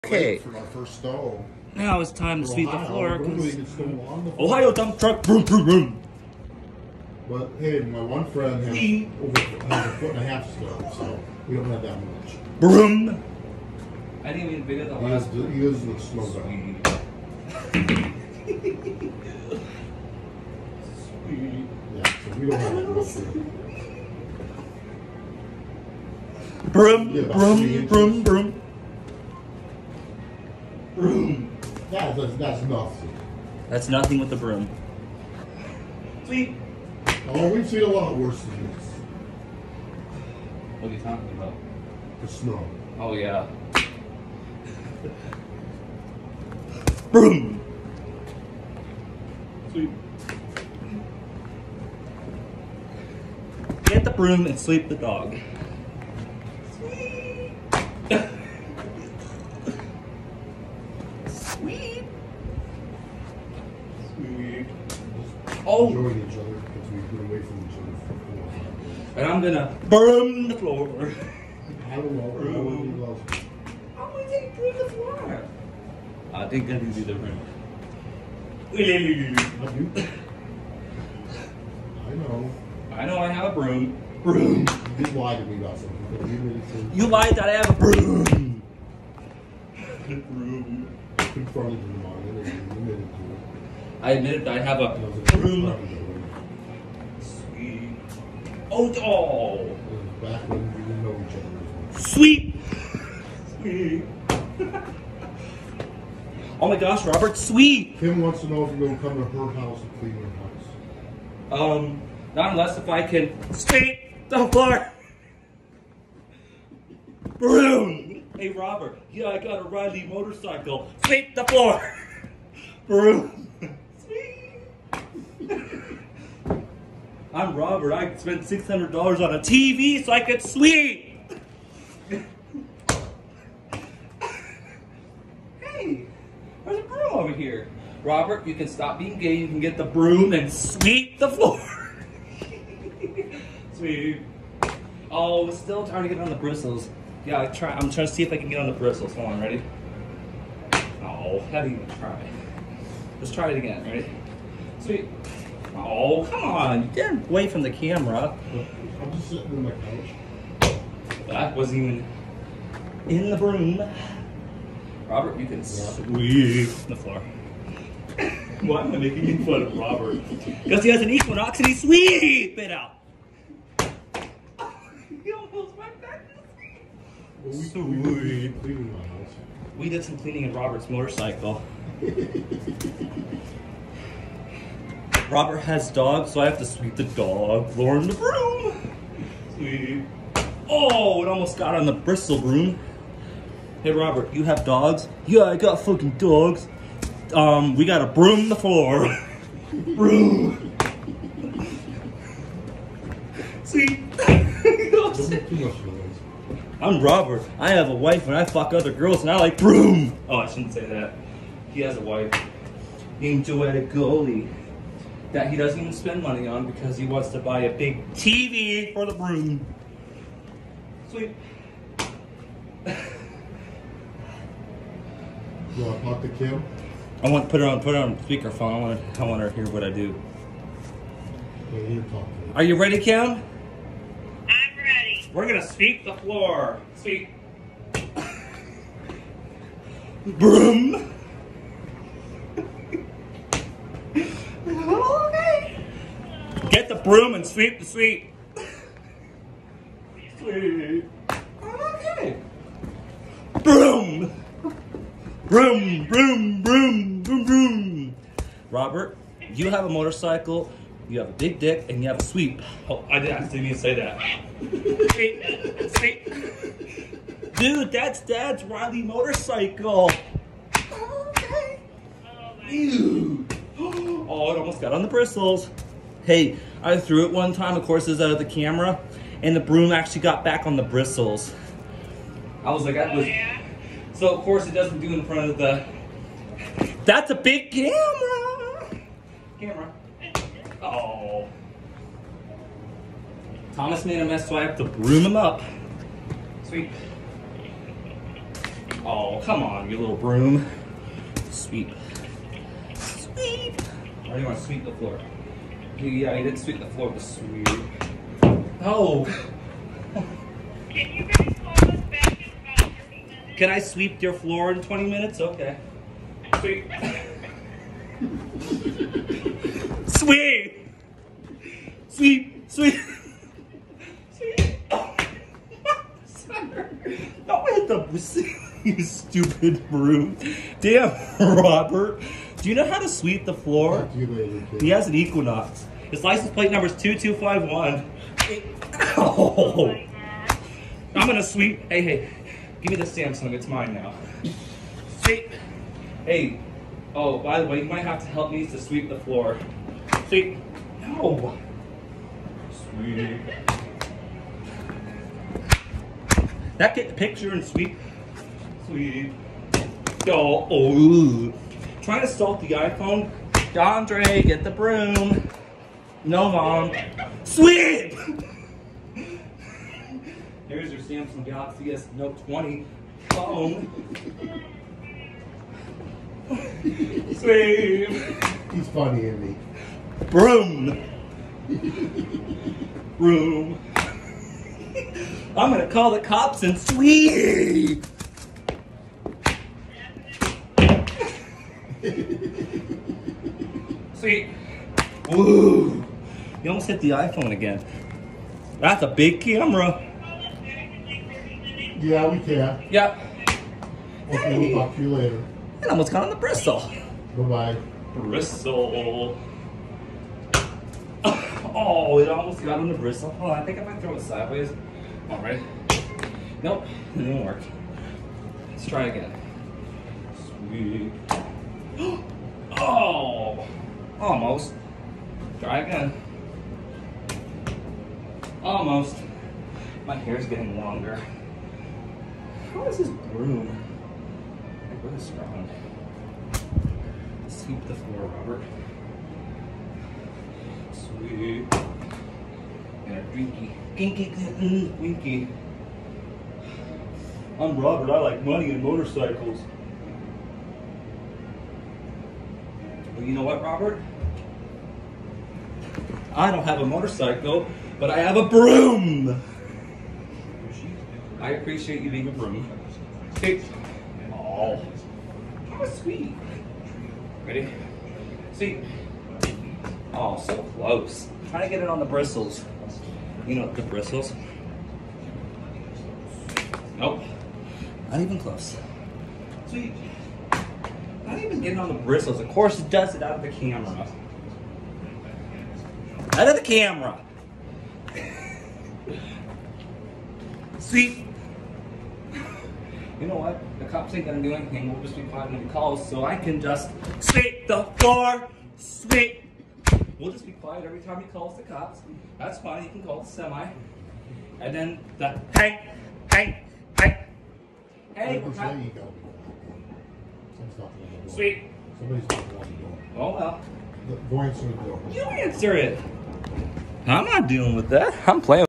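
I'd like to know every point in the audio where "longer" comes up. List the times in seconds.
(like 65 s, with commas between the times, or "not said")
430 s.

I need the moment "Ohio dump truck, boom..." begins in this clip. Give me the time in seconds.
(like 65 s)
4 s.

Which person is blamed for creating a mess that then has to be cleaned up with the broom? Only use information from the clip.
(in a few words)
Thomas.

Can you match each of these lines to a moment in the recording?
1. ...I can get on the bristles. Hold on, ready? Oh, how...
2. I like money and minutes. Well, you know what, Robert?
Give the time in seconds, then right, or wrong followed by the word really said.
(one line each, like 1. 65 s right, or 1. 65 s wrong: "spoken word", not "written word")
1. 148 s right
2. 448 s wrong: "motorcycles", not "minutes".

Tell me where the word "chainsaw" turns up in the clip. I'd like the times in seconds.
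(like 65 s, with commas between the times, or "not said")
not said.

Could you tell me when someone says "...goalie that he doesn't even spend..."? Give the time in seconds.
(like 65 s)
213 s.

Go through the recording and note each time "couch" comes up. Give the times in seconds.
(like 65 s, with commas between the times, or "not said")
159 s.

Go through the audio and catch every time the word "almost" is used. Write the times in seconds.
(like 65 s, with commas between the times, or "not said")
175 s, 191 s, 274 s, 396 s, 405 s, 412 s, 424 s, 428 s.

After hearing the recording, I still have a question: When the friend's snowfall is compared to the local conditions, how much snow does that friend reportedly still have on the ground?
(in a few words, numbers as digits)
a foot and a half.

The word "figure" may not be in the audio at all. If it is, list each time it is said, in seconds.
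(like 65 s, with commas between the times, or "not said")
14 s.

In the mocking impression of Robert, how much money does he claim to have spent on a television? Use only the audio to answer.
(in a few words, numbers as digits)
$600.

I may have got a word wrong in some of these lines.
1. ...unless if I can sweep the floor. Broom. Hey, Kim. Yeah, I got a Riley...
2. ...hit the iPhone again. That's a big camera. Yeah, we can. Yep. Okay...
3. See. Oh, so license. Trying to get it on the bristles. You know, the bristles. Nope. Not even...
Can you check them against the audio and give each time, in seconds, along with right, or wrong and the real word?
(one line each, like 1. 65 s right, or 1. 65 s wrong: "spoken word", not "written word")
1. 112 s wrong: "Robert", not "Kim"
2. 396 s right
3. 468 s wrong: "close", not "license".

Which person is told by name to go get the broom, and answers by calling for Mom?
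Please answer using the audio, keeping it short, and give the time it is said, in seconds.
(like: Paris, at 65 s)
Andrei, at 363 s.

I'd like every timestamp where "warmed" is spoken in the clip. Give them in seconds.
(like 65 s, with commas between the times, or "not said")
not said.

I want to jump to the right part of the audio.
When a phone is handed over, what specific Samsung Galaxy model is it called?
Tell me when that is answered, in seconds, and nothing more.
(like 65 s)
371 s.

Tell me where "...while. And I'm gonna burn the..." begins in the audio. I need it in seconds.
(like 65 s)
69 s.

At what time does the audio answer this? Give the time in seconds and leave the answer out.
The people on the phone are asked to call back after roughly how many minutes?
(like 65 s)
311 s.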